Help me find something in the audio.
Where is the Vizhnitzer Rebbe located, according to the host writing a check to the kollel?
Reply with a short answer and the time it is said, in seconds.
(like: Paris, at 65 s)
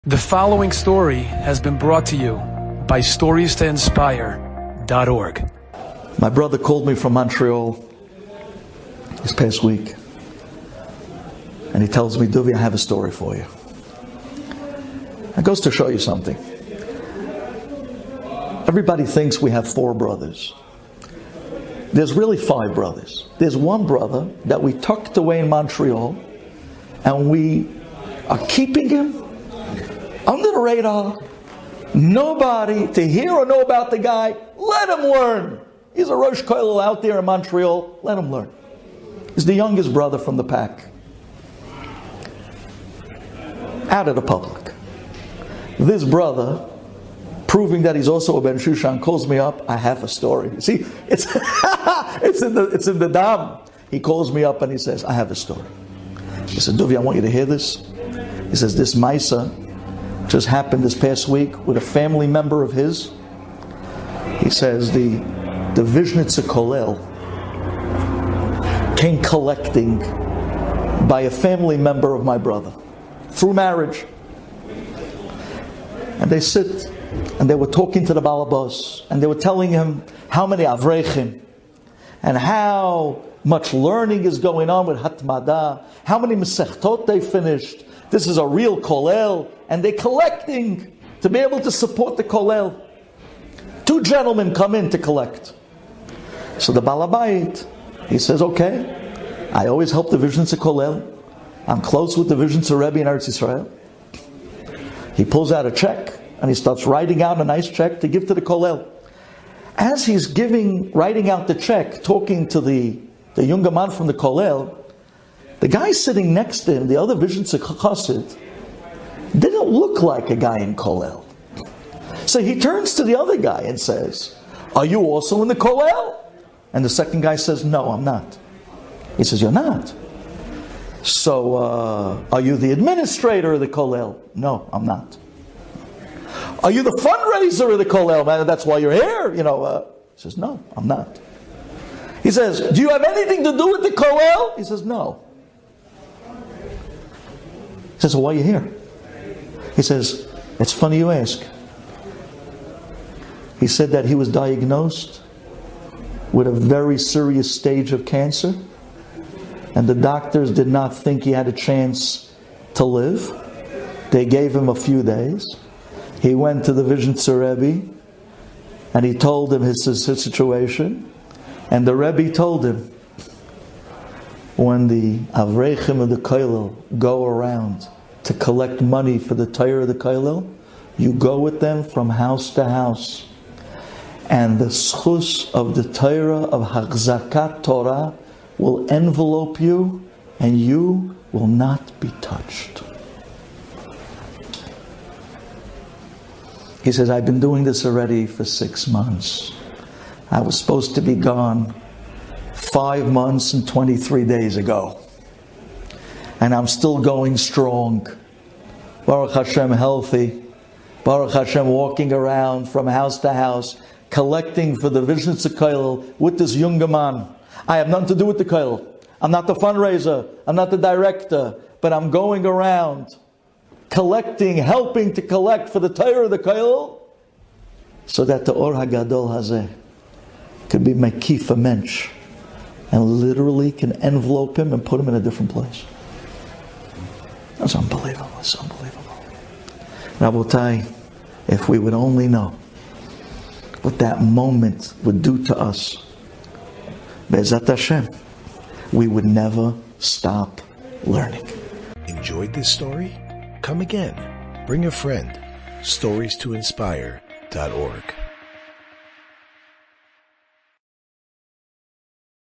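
Eretz Israel, at 103 s.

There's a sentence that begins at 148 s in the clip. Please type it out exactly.
He says, well, why are you here?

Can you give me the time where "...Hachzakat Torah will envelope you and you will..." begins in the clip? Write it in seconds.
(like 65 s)
186 s.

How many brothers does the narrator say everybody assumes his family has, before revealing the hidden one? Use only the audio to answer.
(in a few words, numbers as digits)
4.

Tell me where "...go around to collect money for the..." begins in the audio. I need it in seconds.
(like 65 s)
176 s.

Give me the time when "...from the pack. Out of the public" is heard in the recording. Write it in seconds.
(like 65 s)
40 s.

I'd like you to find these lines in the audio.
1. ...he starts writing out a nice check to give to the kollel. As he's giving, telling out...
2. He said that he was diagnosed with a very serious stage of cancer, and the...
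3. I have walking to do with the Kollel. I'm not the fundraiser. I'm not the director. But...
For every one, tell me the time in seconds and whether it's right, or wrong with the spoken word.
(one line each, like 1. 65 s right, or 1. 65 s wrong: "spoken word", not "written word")
1. 106 s wrong: "writing", not "telling"
2. 153 s right
3. 217 s wrong: "nothing", not "walking".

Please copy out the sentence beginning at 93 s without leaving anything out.
Two gentlemen come in to collect.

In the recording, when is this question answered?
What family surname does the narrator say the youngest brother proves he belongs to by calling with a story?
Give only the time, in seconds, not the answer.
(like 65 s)
48 s.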